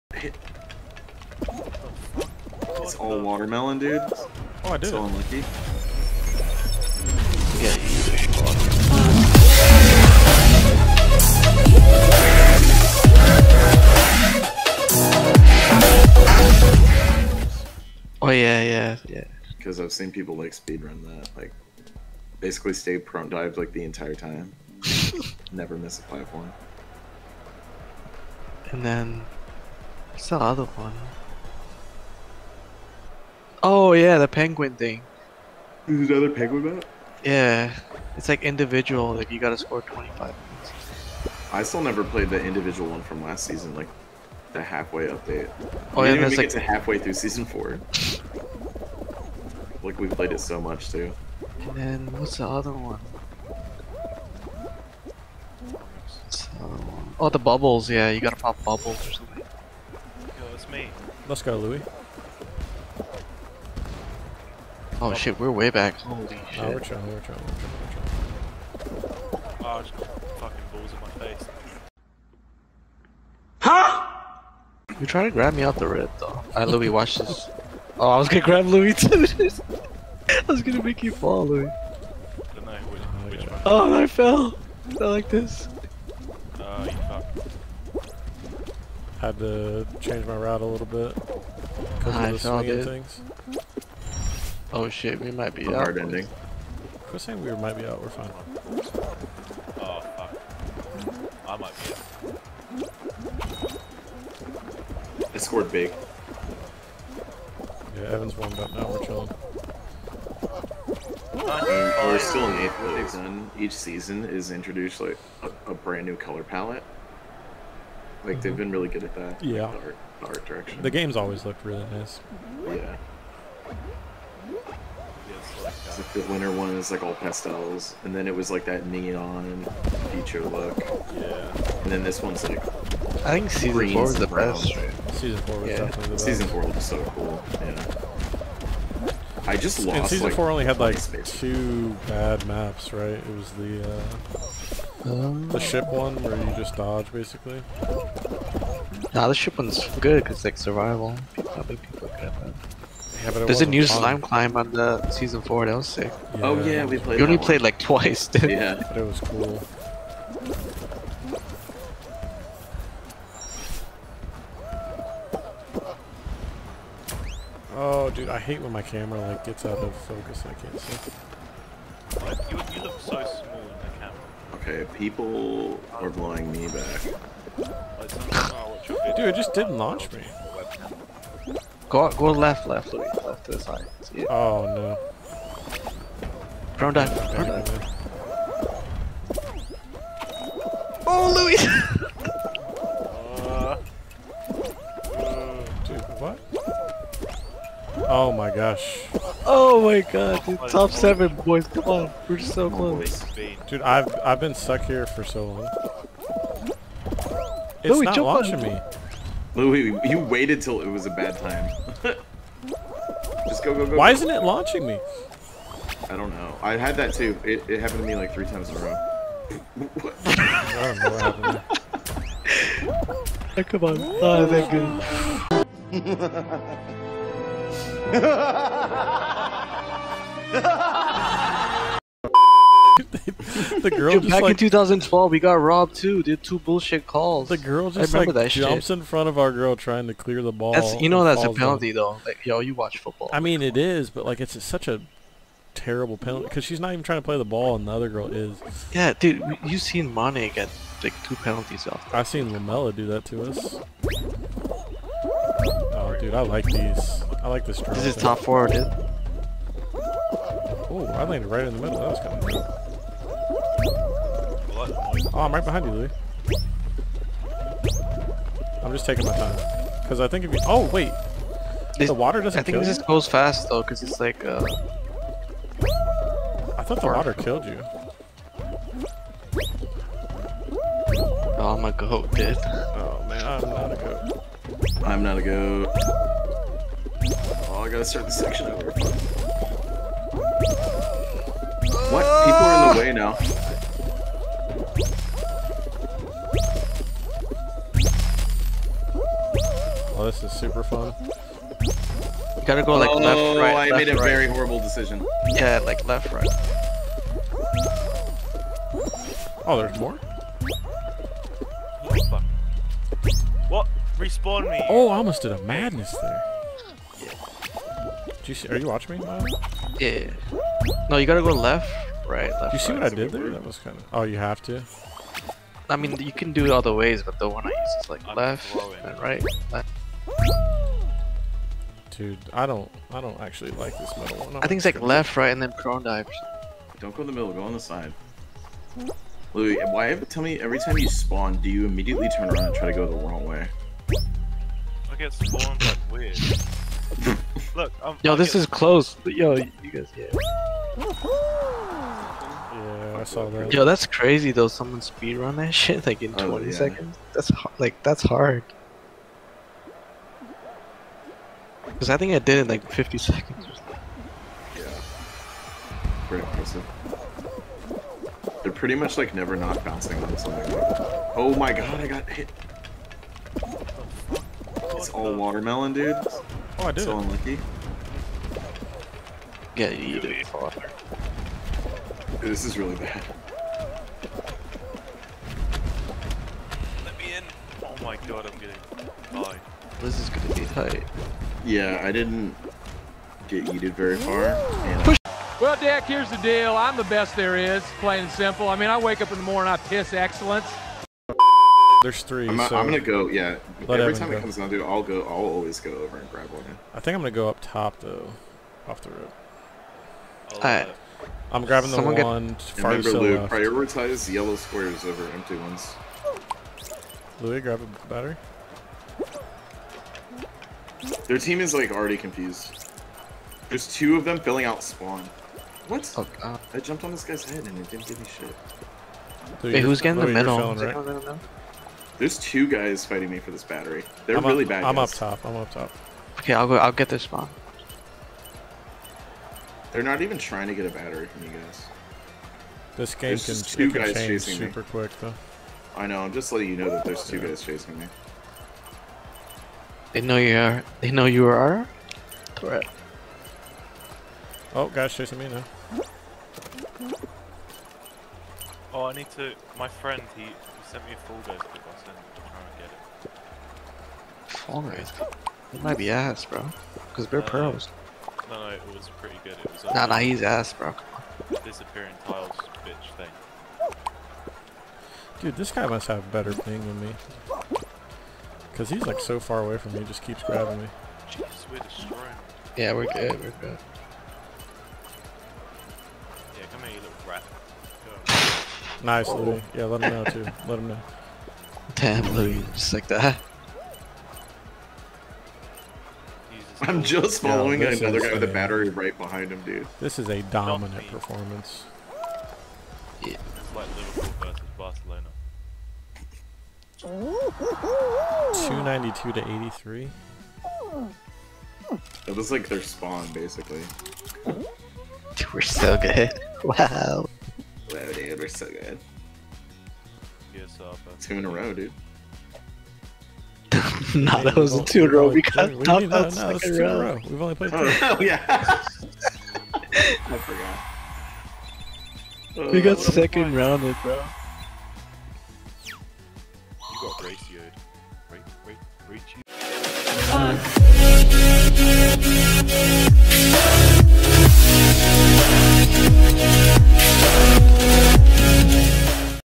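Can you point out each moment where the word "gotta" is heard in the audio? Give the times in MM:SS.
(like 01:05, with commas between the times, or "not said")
00:39, 00:58, 04:47, 05:02, 05:21.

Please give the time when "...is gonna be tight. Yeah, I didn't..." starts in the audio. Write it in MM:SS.
06:30.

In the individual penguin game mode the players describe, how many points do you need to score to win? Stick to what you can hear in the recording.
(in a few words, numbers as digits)
25.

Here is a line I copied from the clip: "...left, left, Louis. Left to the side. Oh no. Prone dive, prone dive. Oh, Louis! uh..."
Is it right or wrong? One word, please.
right.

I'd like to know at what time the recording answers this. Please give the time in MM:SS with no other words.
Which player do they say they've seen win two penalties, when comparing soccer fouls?
04:10.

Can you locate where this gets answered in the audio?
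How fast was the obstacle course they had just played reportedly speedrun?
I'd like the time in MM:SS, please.
05:56.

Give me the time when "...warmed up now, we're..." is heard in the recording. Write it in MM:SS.
01:48.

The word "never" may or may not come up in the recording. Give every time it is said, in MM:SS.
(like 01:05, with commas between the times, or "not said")
00:25, 00:41, 06:09.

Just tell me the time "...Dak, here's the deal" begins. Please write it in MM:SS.
06:35.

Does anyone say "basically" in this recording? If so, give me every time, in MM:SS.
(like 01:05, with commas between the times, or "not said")
00:22, 02:27, 08:33.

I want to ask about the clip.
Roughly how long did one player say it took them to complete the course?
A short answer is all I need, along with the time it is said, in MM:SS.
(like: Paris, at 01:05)
50 seconds, at 06:02.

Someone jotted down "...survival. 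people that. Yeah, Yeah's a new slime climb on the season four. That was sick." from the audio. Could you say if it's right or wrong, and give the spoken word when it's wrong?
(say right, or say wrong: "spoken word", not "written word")
wrong: "There", not "Yeah".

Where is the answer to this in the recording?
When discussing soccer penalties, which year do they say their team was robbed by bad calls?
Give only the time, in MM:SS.
03:54.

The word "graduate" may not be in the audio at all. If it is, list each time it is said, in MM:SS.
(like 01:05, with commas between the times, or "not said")
not said.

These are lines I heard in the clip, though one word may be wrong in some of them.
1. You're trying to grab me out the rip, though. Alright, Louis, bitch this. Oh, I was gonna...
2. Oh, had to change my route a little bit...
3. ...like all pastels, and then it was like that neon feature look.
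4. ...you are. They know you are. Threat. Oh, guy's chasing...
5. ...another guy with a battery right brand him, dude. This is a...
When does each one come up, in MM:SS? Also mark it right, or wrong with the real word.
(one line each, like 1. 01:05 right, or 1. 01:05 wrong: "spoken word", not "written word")
1. 01:14 wrong: "watch", not "bitch"
2. 01:26 right
3. 02:06 right
4. 07:30 right
5. 08:17 wrong: "behind", not "brand".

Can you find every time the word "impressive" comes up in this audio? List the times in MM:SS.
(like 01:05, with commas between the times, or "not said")
06:06.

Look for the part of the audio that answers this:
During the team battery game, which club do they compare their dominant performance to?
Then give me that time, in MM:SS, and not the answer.
08:23.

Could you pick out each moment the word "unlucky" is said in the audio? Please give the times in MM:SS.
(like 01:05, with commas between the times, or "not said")
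00:05, 06:17.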